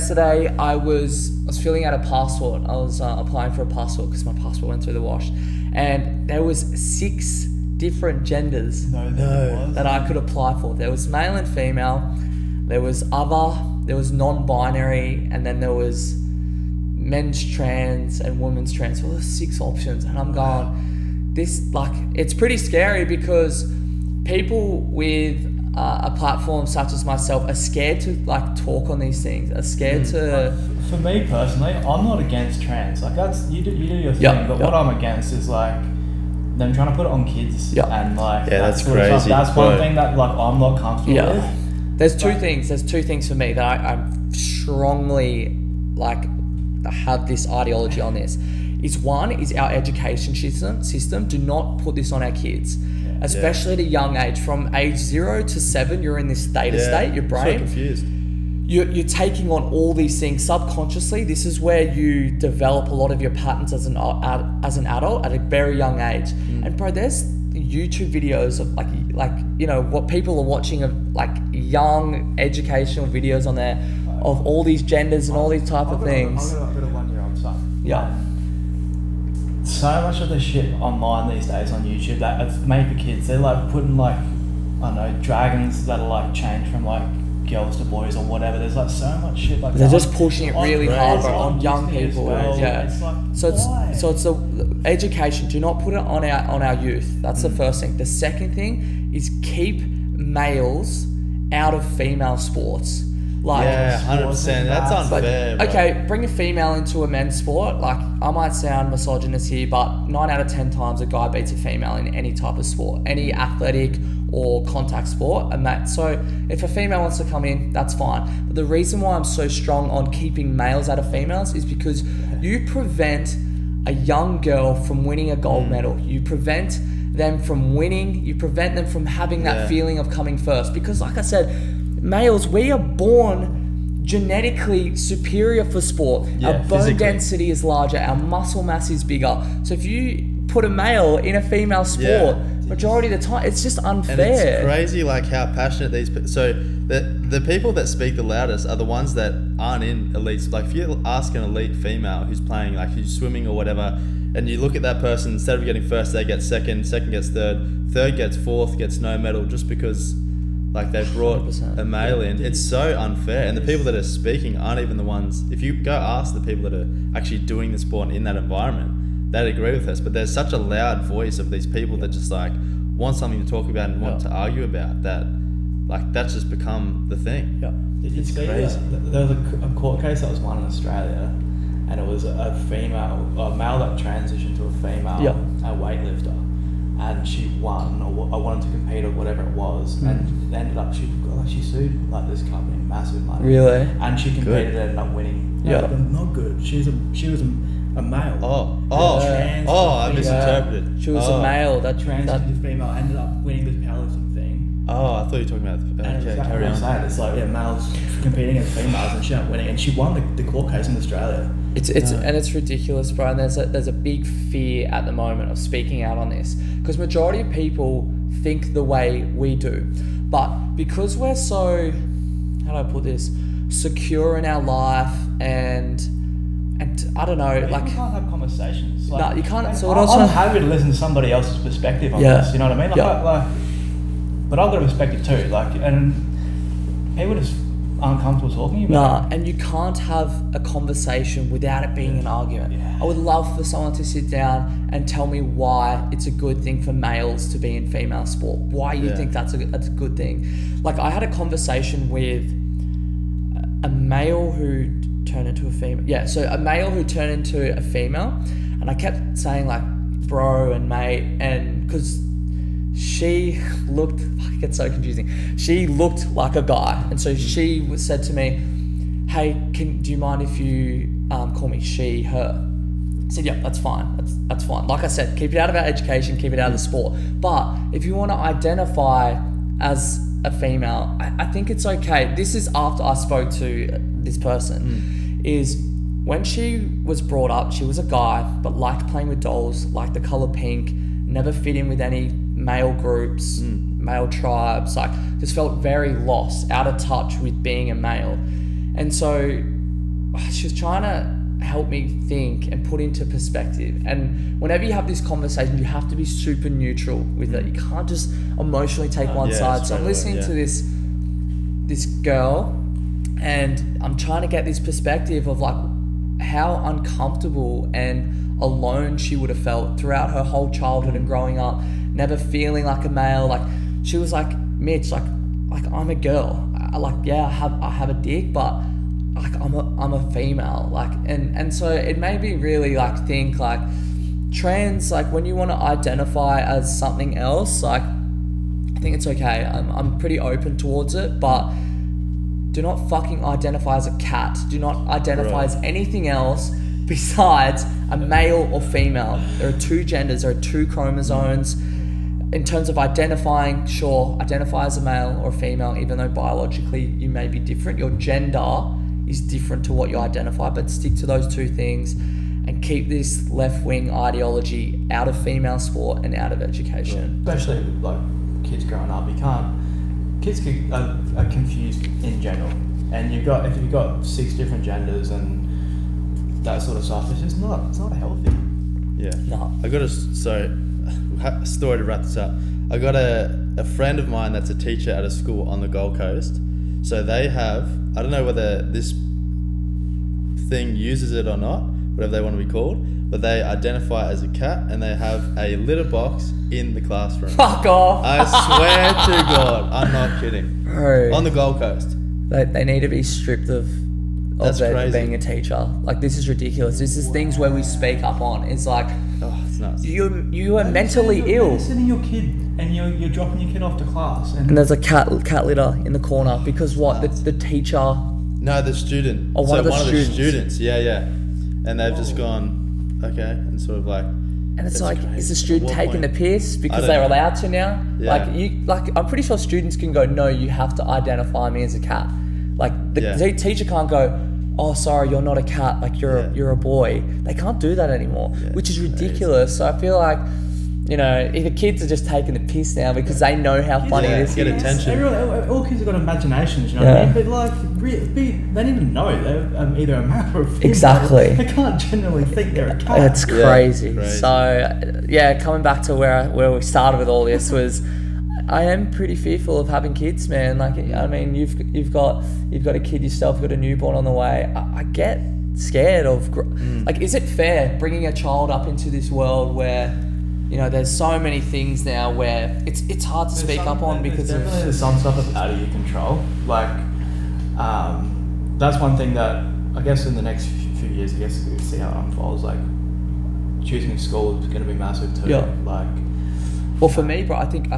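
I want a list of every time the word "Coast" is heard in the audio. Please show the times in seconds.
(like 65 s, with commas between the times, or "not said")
386 s, 401 s.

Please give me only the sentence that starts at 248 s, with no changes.
Why you think that's a that's a good thing?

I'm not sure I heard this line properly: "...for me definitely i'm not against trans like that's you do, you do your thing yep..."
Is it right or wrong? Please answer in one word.
wrong.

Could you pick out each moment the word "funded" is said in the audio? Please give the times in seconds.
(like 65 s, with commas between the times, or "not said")
not said.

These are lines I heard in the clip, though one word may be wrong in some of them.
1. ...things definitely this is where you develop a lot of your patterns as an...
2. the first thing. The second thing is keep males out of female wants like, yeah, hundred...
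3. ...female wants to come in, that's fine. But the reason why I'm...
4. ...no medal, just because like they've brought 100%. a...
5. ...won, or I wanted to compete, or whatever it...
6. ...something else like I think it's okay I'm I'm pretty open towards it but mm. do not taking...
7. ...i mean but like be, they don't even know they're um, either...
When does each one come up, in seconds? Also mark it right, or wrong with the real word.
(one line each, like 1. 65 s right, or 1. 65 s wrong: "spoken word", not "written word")
1. 60 s wrong: "subconsciously", not "definitely"
2. 97 s wrong: "sports", not "wants"
3. 116 s right
4. 158 s right
5. 187 s right
6. 336 s wrong: "fucking", not "taking"
7. 447 s right.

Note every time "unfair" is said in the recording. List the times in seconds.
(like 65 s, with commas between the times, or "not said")
104 s, 143 s, 162 s.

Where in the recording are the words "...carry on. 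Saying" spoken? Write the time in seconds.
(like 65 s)
206 s.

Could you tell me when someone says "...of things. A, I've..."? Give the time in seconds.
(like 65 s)
75 s.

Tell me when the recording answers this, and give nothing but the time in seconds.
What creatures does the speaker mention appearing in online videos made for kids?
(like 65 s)
85 s.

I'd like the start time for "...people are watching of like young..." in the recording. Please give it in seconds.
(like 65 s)
70 s.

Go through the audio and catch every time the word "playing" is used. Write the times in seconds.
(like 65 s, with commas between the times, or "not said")
152 s, 289 s.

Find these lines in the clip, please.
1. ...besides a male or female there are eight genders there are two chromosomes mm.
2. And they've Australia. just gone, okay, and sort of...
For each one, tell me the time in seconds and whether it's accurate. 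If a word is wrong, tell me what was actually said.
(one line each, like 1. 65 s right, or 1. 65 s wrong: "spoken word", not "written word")
1. 347 s wrong: "two", not "eight"
2. 421 s wrong: "Whoa", not "Australia".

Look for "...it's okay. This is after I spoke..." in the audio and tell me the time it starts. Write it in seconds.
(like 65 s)
281 s.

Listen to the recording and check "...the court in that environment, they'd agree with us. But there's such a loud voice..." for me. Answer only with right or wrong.
wrong.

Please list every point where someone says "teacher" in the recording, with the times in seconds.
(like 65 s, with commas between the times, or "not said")
384 s, 405 s, 417 s, 433 s.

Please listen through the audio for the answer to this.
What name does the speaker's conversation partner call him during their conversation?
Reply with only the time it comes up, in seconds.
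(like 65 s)
324 s.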